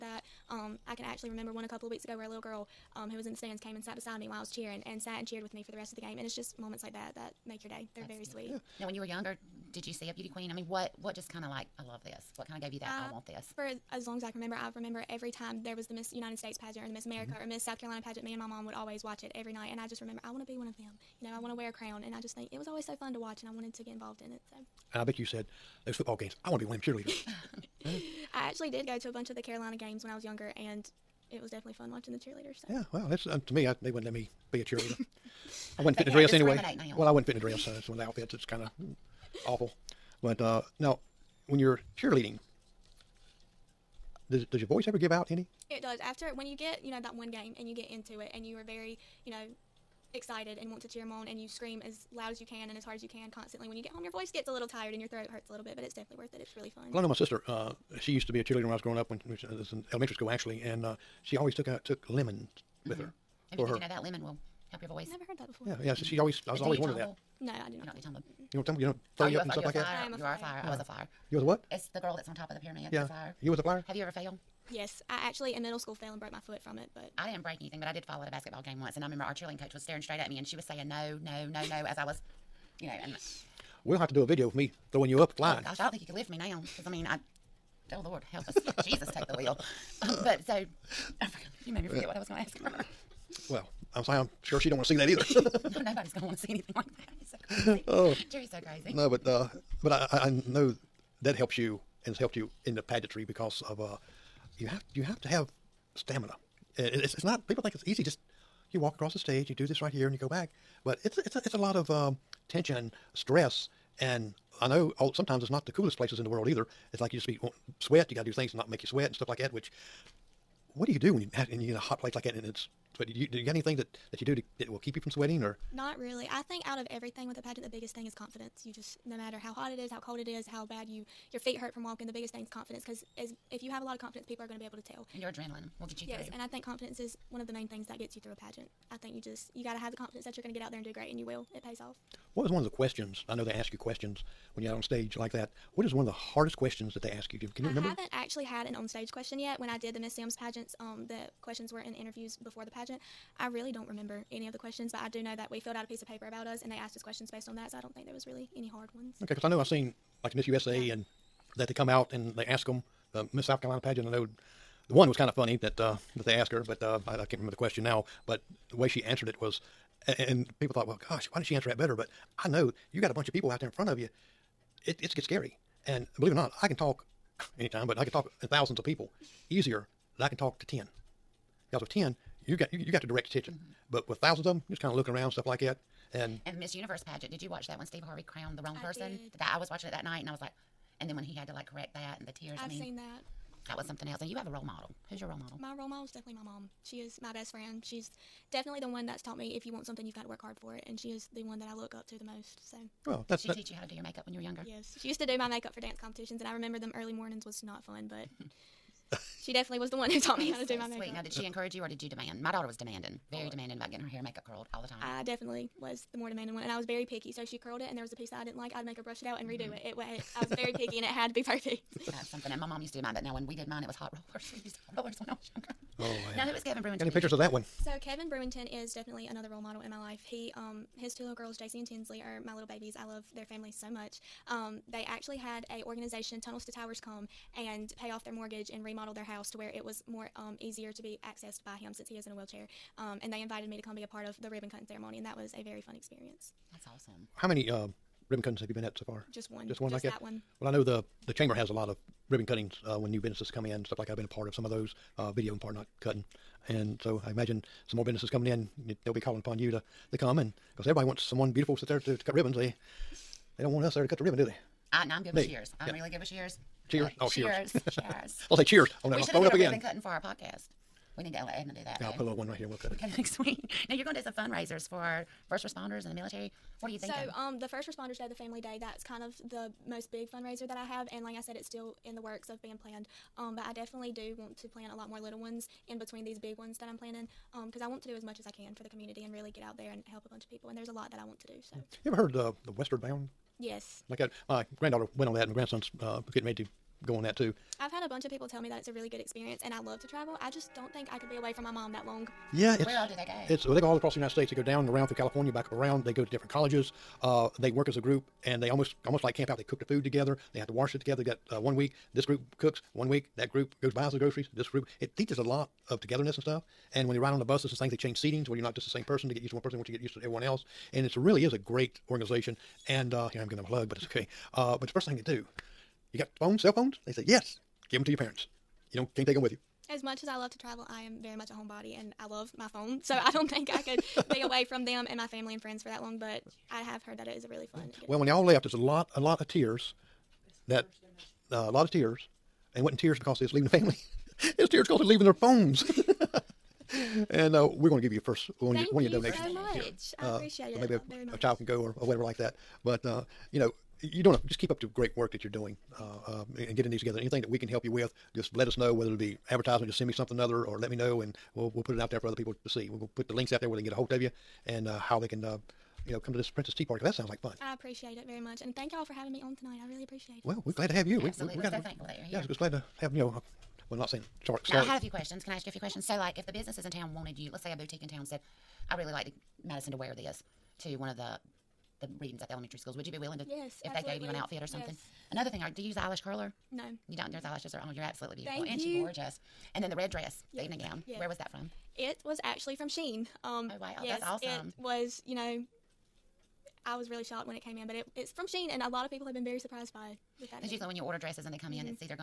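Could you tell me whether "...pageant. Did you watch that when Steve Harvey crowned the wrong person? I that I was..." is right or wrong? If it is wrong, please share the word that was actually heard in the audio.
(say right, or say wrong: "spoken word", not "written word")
right.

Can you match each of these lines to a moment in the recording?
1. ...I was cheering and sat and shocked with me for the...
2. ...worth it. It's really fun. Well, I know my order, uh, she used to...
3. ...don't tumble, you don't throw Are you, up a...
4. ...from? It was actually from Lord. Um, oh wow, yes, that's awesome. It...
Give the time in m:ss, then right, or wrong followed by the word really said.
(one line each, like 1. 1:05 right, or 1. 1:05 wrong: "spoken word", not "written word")
1. 0:04 wrong: "cheered", not "shocked"
2. 0:56 wrong: "sister", not "order"
3. 1:08 right
4. 6:31 wrong: "Shein", not "Lord".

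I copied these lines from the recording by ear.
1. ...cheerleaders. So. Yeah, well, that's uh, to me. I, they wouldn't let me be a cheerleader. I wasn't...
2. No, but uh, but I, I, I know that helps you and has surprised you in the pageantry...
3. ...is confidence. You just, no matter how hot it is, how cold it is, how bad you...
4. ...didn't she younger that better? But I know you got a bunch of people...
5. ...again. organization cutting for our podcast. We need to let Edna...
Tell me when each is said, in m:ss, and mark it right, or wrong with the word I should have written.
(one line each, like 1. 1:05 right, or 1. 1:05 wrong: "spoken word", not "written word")
1. 0:32 right
2. 1:38 wrong: "helped", not "surprised"
3. 2:08 right
4. 2:51 wrong: "answer", not "younger"
5. 4:29 wrong: "ribbon", not "organization".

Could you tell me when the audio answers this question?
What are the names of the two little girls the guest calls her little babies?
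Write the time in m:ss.
3:51.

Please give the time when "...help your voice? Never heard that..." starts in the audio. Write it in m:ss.
1:04.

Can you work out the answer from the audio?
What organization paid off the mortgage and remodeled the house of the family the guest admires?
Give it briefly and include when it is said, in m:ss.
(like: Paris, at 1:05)
Tunnels to Towers, at 3:56.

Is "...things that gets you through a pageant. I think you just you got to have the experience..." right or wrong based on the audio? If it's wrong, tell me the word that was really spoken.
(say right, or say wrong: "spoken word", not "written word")
wrong: "confidence", not "experience".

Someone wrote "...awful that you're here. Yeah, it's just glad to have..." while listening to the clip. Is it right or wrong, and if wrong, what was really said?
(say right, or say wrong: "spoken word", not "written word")
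wrong: "thankful", not "awful".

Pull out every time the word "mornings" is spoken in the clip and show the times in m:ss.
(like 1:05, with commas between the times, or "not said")
3:27.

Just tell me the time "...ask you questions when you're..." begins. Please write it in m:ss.
2:23.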